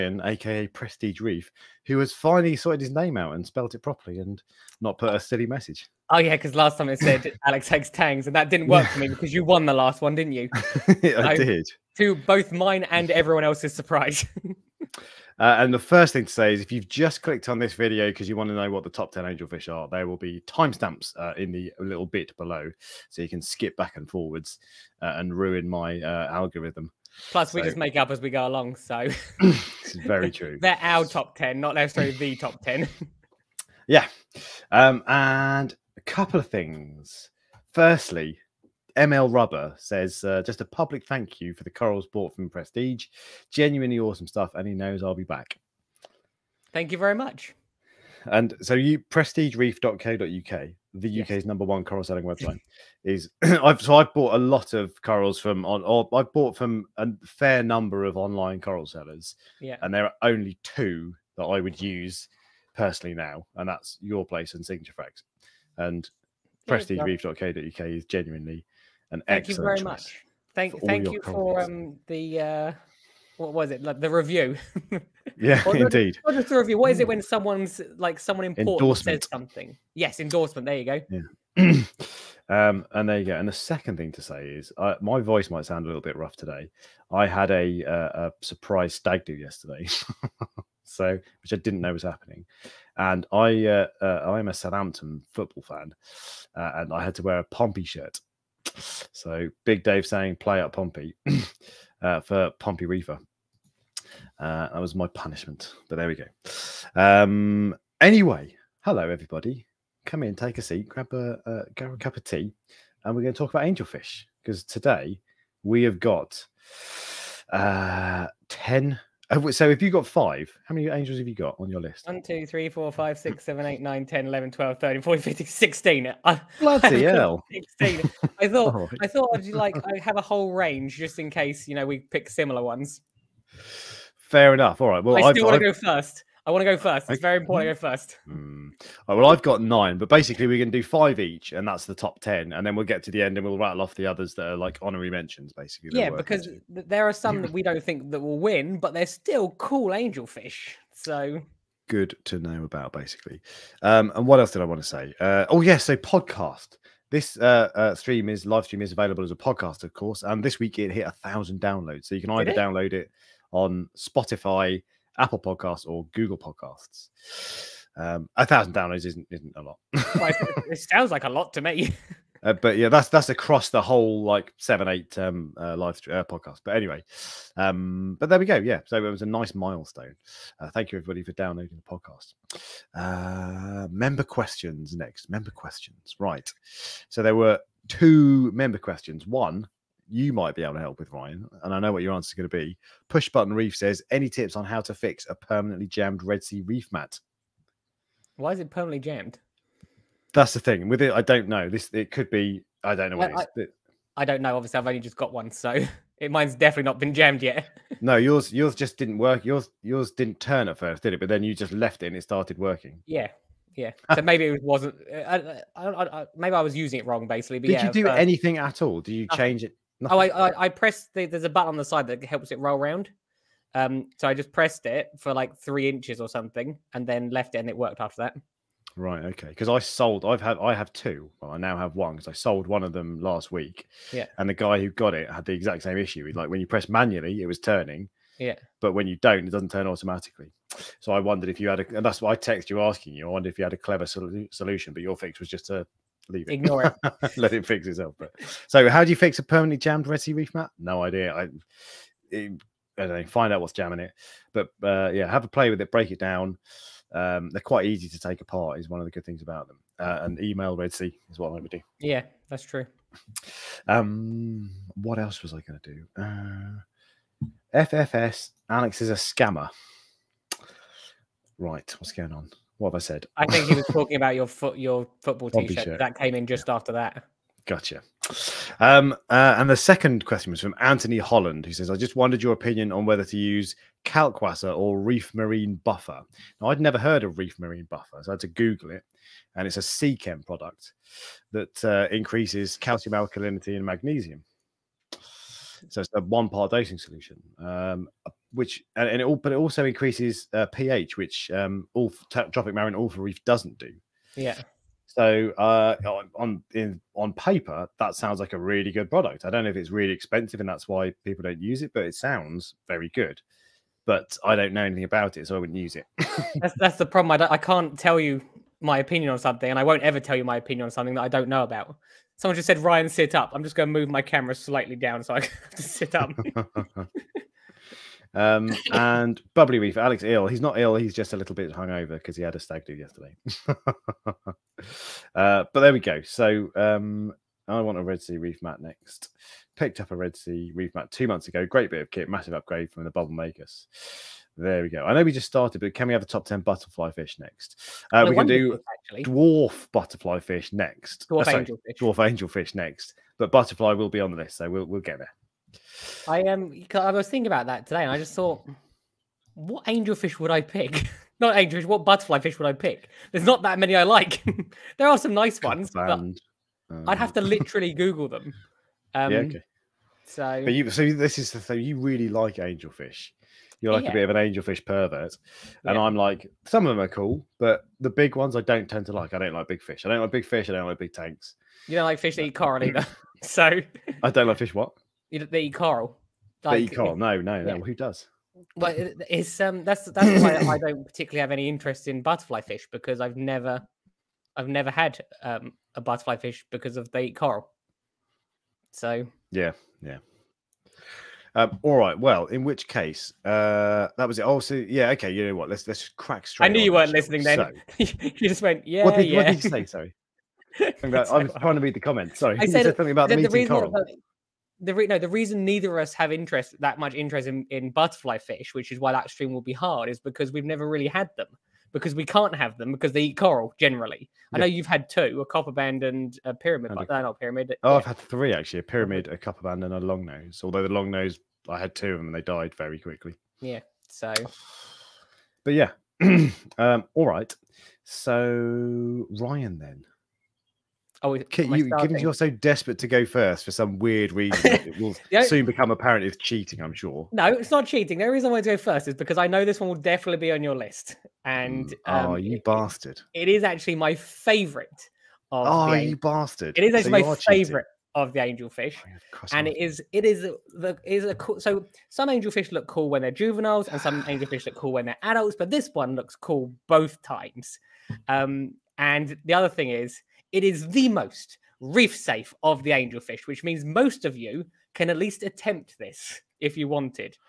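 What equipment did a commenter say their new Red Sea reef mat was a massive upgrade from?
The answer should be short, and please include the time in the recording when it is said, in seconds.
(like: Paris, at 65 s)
Bubble Makers, at 343 s.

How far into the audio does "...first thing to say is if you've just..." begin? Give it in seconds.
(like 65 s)
15 s.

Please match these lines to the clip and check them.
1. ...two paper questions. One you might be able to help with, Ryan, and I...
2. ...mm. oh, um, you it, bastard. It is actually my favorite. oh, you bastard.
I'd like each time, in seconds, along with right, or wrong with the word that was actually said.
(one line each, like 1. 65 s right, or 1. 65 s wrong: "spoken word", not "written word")
1. 187 s wrong: "member", not "paper"
2. 451 s right.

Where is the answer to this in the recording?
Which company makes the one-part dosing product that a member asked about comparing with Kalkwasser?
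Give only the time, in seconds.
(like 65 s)
289 s.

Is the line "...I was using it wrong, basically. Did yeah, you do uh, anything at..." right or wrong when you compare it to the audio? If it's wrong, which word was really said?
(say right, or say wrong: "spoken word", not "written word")
right.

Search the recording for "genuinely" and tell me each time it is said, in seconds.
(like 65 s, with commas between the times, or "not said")
43 s, 68 s.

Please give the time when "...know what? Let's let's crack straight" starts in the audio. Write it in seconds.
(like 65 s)
405 s.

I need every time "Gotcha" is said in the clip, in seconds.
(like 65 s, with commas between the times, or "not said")
277 s.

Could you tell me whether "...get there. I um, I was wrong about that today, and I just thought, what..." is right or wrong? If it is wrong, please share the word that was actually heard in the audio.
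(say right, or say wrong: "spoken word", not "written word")
wrong: "thinking", not "wrong".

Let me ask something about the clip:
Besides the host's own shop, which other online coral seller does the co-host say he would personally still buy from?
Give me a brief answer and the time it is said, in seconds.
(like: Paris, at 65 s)
Signature Frags, at 64 s.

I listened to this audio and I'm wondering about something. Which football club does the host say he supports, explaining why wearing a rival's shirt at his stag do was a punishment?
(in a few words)
Southampton.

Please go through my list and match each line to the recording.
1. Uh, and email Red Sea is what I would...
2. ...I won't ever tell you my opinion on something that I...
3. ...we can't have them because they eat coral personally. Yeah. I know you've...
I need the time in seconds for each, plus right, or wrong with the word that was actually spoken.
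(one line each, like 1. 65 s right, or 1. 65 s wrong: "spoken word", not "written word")
1. 259 s right
2. 319 s right
3. 422 s wrong: "generally", not "personally".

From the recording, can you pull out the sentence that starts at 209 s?
Yours yours didn't turn at first, did it?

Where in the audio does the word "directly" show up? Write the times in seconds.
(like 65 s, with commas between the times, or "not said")
not said.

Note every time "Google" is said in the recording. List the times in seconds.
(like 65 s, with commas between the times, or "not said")
166 s, 288 s, 367 s.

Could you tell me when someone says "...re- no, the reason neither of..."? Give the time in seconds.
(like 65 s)
414 s.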